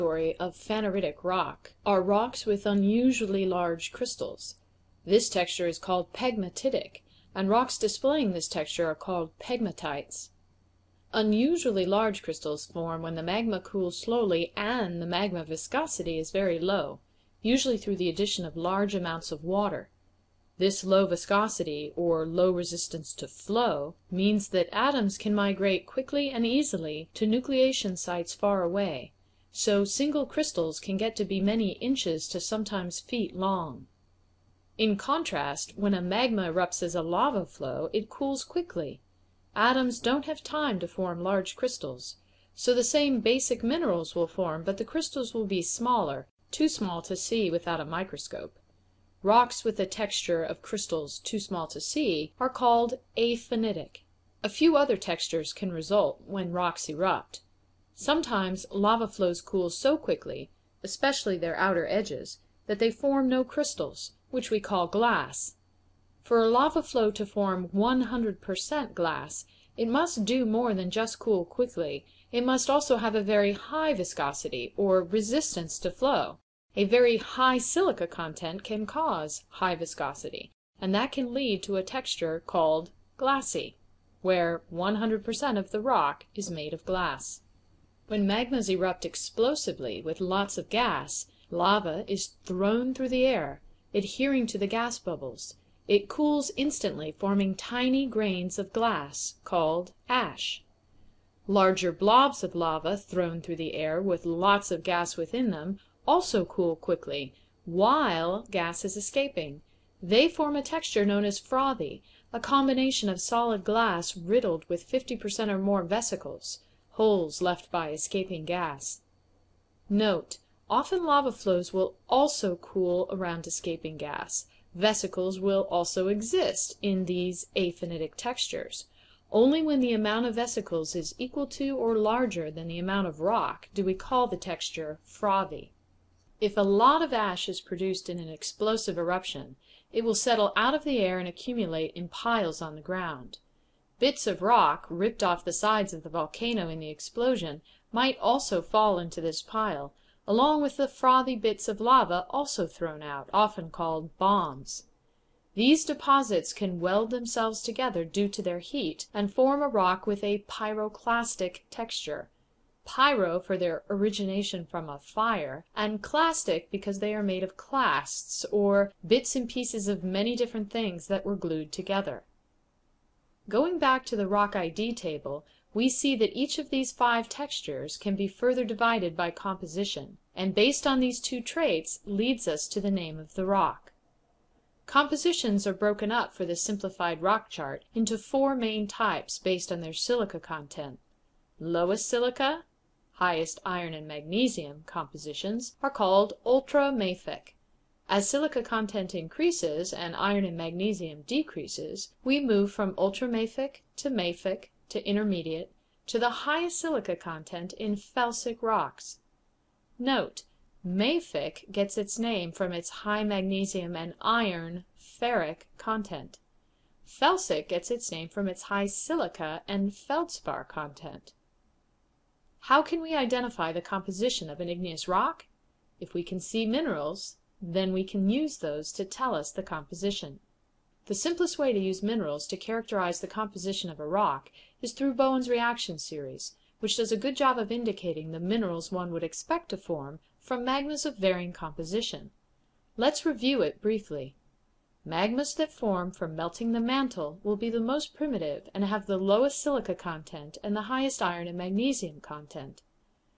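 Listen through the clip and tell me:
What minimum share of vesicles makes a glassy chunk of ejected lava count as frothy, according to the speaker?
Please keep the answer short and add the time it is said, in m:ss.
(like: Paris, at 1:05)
50 percent, at 1:54.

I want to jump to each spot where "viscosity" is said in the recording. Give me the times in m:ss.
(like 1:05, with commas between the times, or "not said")
0:15, 0:21, 1:13, 1:19.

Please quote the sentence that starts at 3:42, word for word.
How can we identify the composition of an igneous rock?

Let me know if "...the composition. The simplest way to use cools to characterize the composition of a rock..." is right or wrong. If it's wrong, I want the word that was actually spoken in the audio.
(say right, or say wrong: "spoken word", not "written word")
wrong: "minerals", not "cools".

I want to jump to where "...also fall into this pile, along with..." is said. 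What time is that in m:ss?
2:28.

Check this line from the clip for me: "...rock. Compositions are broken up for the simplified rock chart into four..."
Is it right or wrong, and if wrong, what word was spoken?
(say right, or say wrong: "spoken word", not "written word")
right.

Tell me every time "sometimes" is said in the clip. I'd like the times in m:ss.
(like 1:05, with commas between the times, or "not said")
0:32, 0:57.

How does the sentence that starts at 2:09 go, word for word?
Only when the amount of vesicles is equal to or larger than the amount of rock do we call the texture frothy.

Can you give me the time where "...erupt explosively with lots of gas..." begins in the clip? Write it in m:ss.
1:28.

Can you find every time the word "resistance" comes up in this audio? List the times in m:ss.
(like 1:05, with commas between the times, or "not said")
0:22, 1:15.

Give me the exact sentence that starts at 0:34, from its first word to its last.
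In contrast, when a magma erupts as a lava flow it cools quickly.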